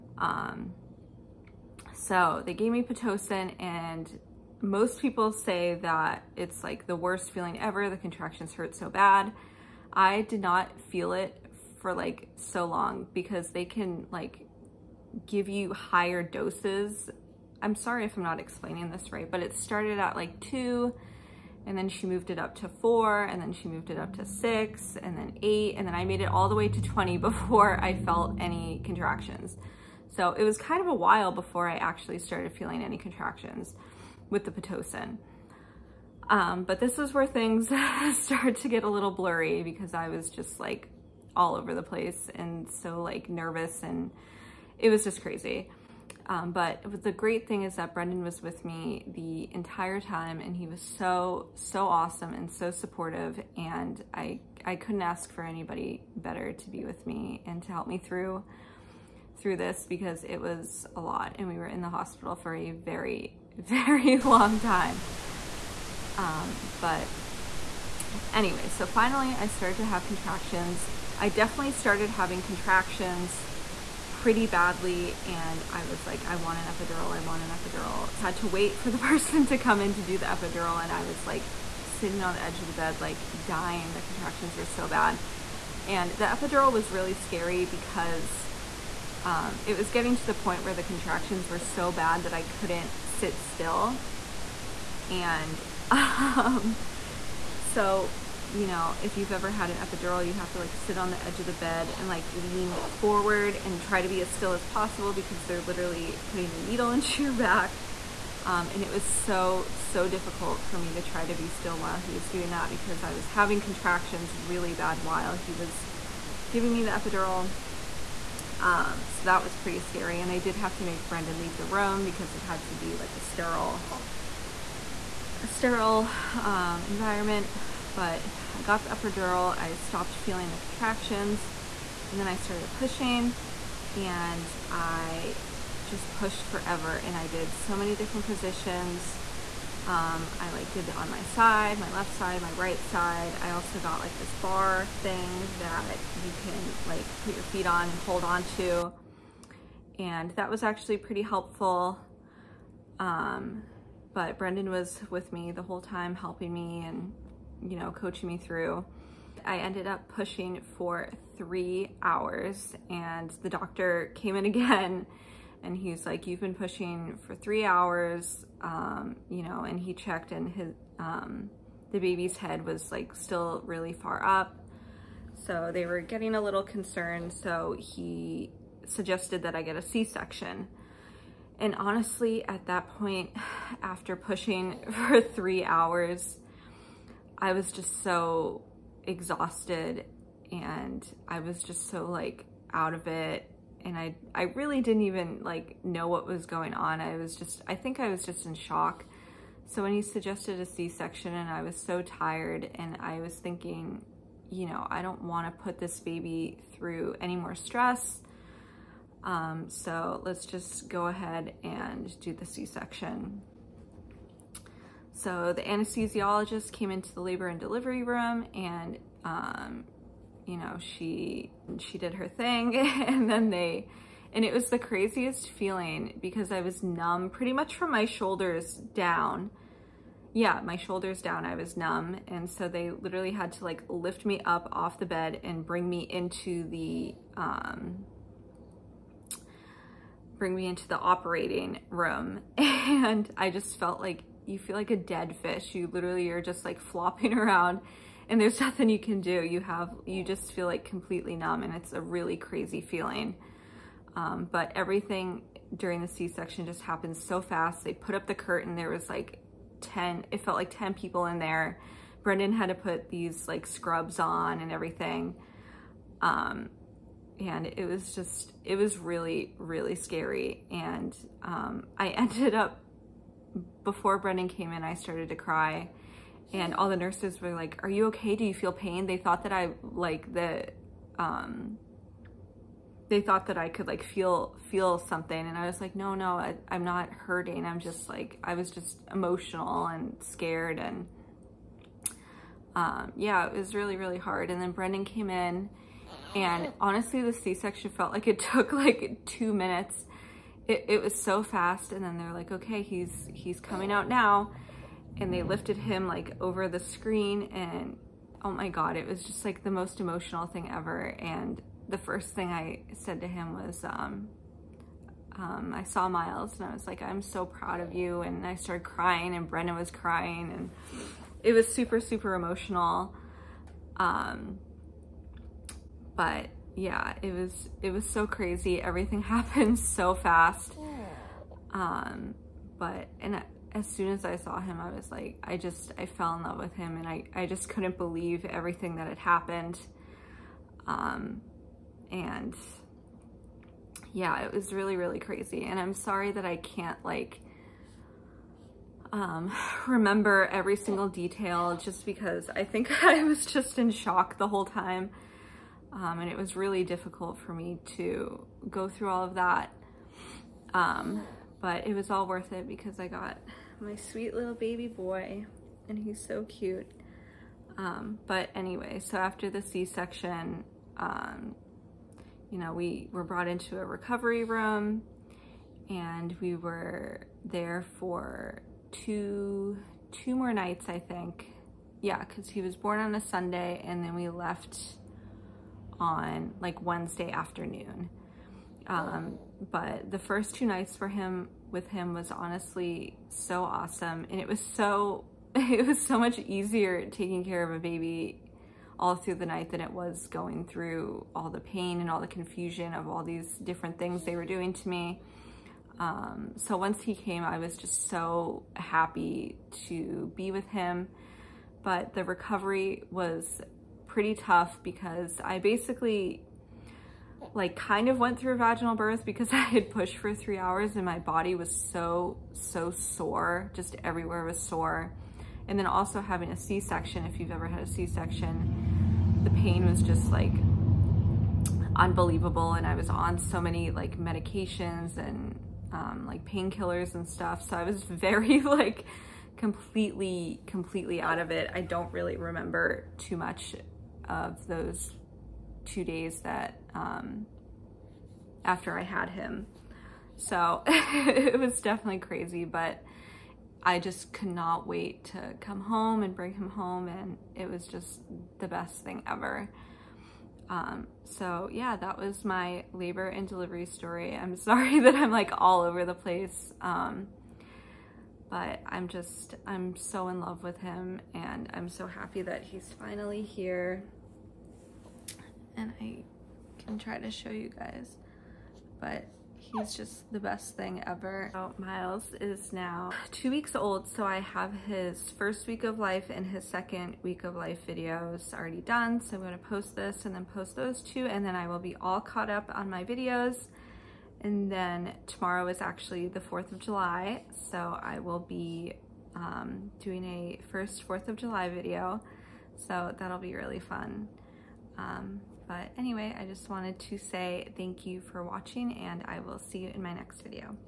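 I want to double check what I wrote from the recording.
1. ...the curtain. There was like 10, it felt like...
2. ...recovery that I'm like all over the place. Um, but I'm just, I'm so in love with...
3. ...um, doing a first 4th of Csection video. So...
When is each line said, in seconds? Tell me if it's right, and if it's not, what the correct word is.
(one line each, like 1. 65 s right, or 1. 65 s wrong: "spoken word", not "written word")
1. 258 s right
2. 464 s wrong: "sorry", not "recovery"
3. 499 s wrong: "July", not "Csection".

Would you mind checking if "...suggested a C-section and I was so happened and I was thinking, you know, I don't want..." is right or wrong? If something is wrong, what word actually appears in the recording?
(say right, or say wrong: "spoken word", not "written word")
wrong: "tired", not "happened".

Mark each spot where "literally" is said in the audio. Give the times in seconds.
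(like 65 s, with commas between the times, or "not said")
105 s, 232 s, 245 s.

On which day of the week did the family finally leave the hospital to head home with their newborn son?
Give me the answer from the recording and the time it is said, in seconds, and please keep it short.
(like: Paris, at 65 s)
Wednesday, at 386 s.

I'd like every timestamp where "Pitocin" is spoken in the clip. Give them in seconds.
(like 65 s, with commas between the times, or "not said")
2 s, 34 s.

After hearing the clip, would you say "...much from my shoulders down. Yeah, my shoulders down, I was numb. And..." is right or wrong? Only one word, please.
right.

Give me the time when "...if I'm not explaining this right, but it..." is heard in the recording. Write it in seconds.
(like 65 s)
18 s.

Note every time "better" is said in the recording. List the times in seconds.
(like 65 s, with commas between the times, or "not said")
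56 s.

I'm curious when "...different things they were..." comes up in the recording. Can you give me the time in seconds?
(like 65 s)
403 s.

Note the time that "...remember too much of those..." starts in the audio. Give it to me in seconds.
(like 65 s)
442 s.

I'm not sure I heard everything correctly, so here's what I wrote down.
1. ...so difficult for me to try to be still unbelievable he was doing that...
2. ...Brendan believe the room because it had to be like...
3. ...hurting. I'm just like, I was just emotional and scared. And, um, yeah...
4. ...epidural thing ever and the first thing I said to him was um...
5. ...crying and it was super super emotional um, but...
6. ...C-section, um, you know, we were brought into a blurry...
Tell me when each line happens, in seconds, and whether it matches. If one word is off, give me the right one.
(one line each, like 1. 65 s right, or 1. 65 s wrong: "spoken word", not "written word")
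1. 109 s wrong: "while", not "unbelievable"
2. 121 s wrong: "leave", not "believe"
3. 287 s right
4. 309 s wrong: "emotional", not "epidural"
5. 319 s right
6. 369 s wrong: "recovery", not "blurry".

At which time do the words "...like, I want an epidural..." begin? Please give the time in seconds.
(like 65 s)
76 s.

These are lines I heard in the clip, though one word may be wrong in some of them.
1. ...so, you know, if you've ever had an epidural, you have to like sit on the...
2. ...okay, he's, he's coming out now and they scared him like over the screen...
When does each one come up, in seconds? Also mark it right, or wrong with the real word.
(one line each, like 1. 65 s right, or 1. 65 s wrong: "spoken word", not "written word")
1. 97 s right
2. 302 s wrong: "lifted", not "scared".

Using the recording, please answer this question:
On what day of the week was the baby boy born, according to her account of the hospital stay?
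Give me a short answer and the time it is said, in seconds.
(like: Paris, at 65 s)
Sunday, at 383 s.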